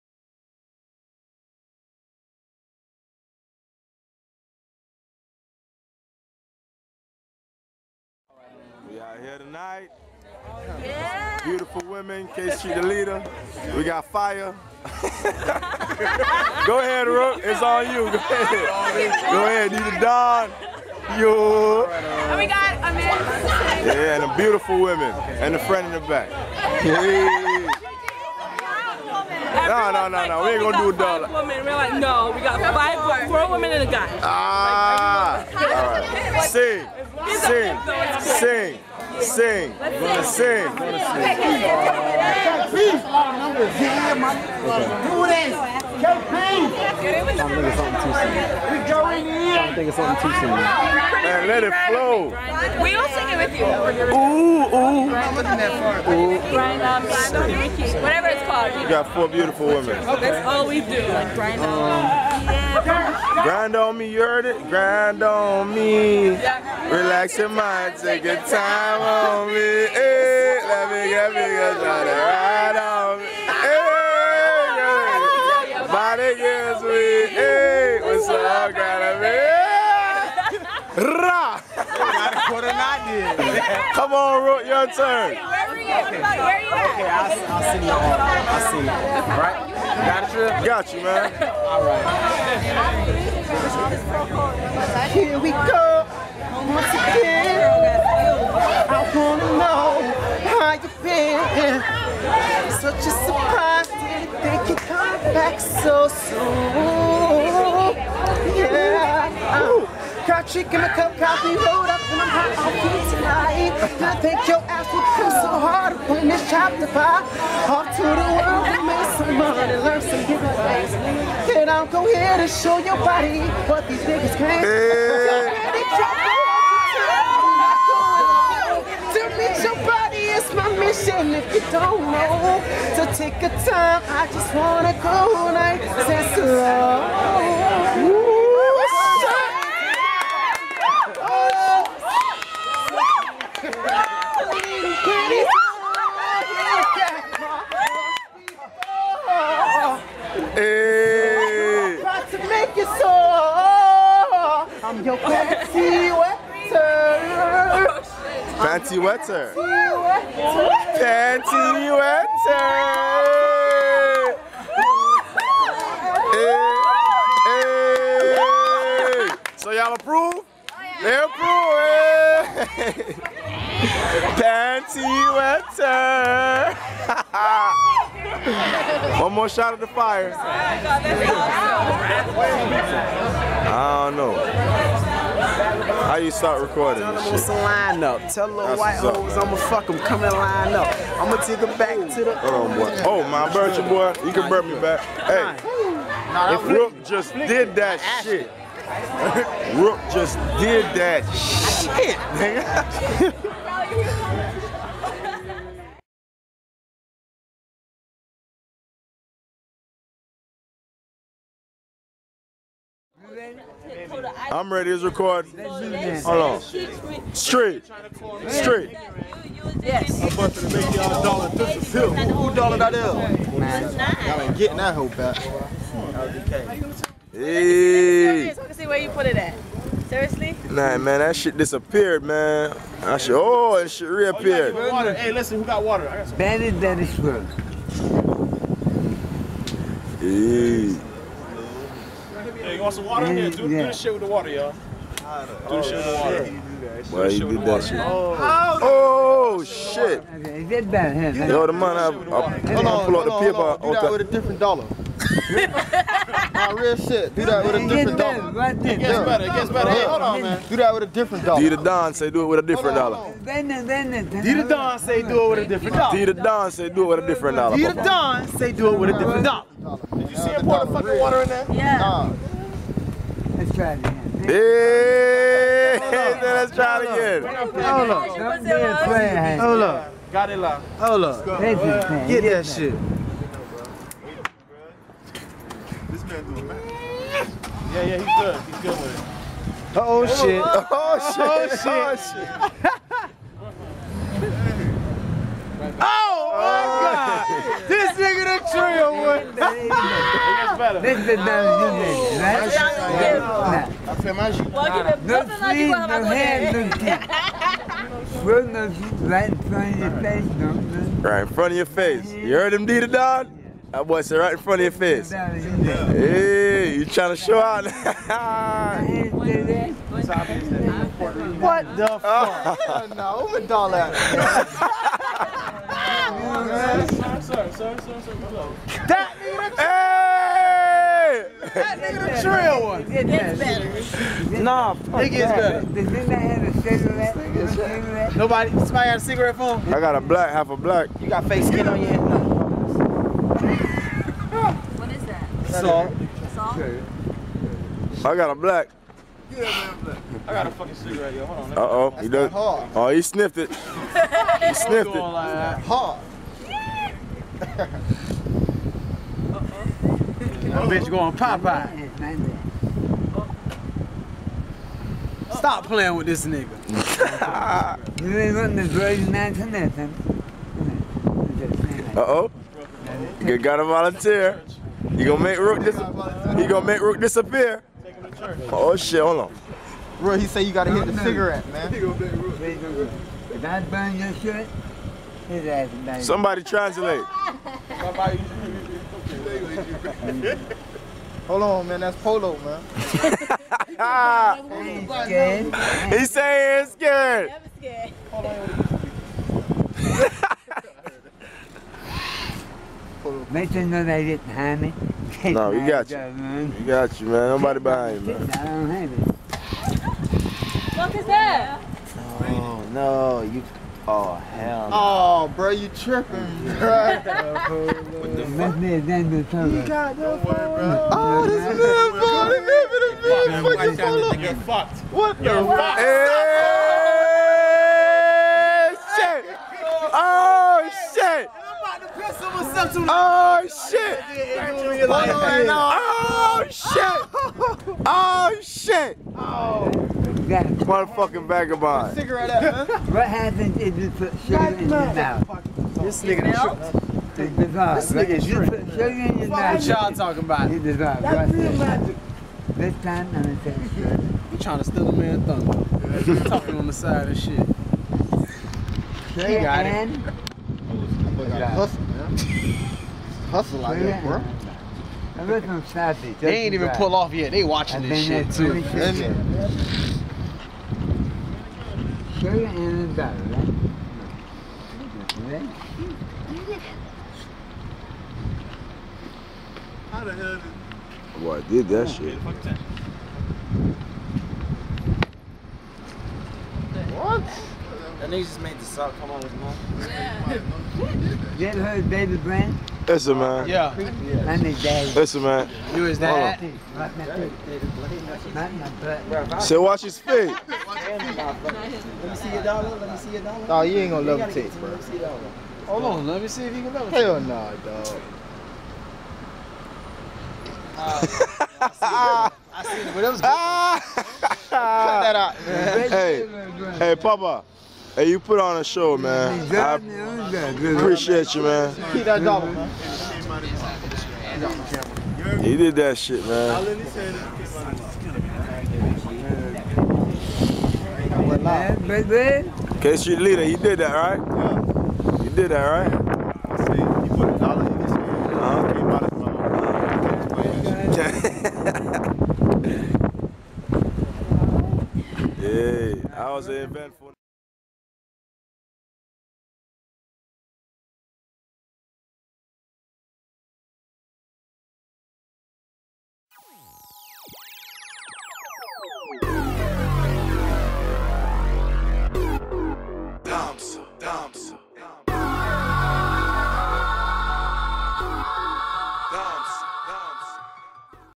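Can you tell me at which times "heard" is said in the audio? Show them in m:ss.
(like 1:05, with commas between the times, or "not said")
1:04, 5:12, 8:11.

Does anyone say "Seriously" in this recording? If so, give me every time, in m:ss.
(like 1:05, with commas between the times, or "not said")
3:50.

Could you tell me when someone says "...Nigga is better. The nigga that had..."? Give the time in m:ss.
5:35.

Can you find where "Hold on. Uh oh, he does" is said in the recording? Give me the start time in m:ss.
5:51.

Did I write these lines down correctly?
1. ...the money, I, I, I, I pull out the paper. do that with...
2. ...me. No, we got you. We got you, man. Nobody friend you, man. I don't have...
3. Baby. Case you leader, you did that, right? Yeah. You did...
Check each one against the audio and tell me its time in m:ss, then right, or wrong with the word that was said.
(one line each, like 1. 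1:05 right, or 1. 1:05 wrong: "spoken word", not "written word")
1. 4:11 right
2. 6:44 wrong: "behind", not "friend"
3. 8:52 right.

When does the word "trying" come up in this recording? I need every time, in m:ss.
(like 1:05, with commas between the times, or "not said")
5:17, 7:34.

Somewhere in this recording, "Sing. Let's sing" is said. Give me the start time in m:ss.
0:39.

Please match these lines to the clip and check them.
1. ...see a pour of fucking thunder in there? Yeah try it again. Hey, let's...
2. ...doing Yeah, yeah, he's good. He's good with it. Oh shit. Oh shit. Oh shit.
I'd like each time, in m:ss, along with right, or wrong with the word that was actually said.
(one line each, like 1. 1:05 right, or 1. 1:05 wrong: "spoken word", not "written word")
1. 4:30 wrong: "water", not "thunder"
2. 4:46 right.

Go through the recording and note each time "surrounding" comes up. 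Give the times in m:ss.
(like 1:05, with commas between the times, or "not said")
not said.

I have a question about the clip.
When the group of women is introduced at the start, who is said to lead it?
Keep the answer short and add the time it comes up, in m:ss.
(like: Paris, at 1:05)
K.C., at 0:12.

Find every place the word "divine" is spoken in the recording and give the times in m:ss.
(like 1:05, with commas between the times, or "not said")
7:30.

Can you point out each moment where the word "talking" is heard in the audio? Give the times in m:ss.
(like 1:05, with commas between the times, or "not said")
7:30, 7:36.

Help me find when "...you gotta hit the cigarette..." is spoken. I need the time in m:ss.
6:20.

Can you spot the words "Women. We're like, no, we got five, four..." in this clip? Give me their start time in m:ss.
0:31.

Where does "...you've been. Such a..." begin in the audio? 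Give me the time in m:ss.
1:40.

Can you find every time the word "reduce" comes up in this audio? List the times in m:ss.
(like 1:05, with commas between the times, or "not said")
not said.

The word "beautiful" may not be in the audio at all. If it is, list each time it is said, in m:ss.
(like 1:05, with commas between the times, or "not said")
0:11, 0:24, 0:59.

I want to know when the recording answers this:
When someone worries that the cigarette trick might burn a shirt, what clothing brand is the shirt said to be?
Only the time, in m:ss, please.
6:32.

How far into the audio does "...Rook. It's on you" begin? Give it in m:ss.
0:17.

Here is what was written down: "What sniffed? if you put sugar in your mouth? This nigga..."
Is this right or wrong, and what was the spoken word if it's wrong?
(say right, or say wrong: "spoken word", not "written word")
wrong: "happened", not "sniffed".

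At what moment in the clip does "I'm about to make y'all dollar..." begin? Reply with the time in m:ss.
3:40.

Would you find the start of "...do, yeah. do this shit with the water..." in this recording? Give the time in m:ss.
4:03.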